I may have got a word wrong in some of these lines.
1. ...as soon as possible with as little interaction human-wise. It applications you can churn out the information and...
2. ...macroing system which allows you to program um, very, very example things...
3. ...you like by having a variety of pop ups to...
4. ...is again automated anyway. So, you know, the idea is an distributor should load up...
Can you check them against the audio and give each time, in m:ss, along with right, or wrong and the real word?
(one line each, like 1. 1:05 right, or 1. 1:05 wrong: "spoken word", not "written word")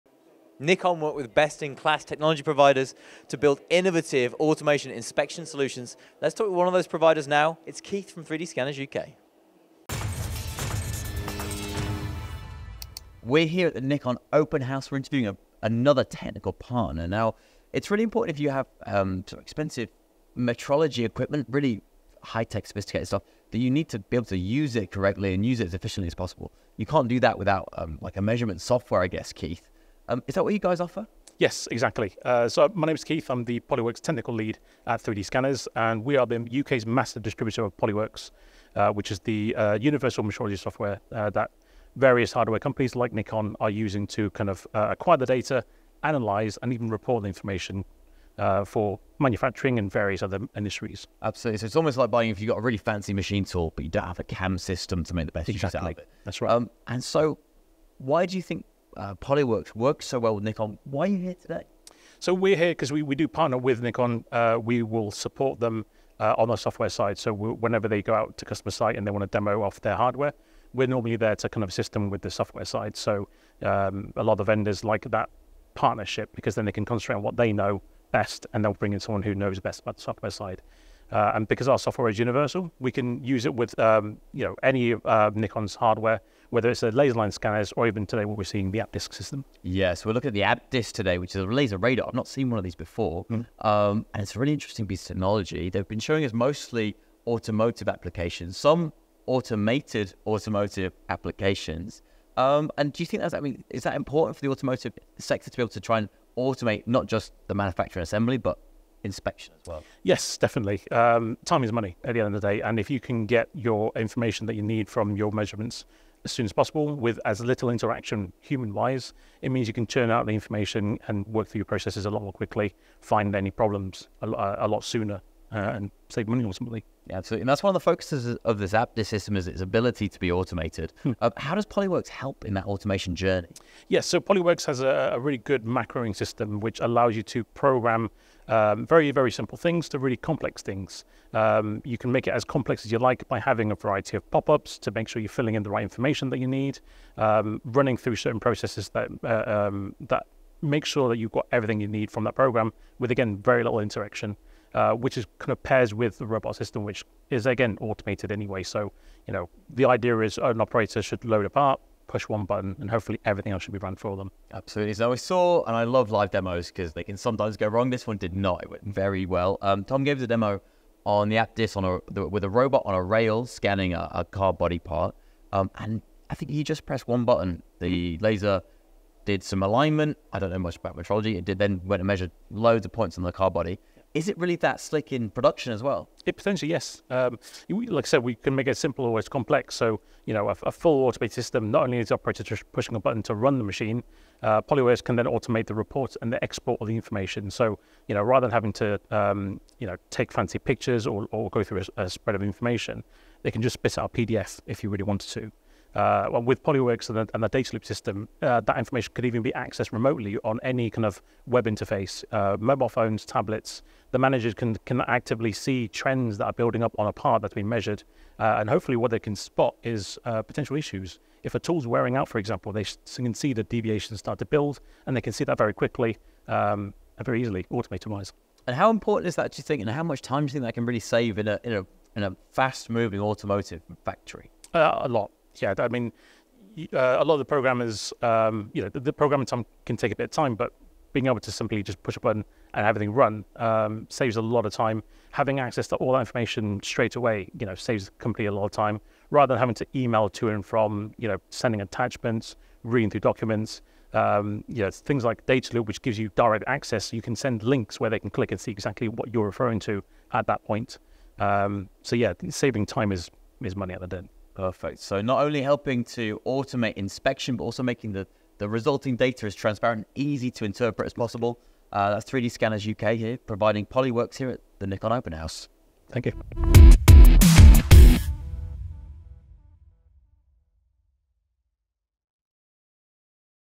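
1. 1:56 wrong: "means", not "applications"
2. 2:15 wrong: "simple", not "example"
3. 2:22 right
4. 2:37 wrong: "operator", not "distributor".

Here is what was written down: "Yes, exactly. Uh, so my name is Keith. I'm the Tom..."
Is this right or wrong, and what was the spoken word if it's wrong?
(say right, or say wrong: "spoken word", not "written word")
wrong: "Polyworks", not "Tom".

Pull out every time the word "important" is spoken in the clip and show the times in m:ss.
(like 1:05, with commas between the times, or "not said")
0:18, 1:43, 3:48.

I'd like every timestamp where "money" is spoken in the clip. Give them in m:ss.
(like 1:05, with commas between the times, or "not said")
1:51, 2:06, 4:23.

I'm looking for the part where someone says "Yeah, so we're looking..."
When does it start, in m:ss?
1:29.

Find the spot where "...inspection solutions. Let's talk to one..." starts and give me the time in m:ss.
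0:04.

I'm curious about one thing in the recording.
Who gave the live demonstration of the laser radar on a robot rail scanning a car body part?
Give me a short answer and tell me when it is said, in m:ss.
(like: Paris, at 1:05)
Tom, at 2:49.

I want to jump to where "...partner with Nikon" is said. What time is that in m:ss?
1:03.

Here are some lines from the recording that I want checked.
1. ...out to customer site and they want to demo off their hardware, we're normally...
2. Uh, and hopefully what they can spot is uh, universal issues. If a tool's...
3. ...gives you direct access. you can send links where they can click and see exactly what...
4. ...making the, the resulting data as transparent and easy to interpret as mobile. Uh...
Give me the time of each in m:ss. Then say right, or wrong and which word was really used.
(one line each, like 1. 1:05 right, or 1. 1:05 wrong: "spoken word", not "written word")
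1. 1:08 right
2. 3:38 wrong: "potential", not "universal"
3. 4:16 right
4. 4:27 wrong: "possible", not "mobile".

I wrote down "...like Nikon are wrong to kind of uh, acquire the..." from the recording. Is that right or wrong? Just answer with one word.
wrong.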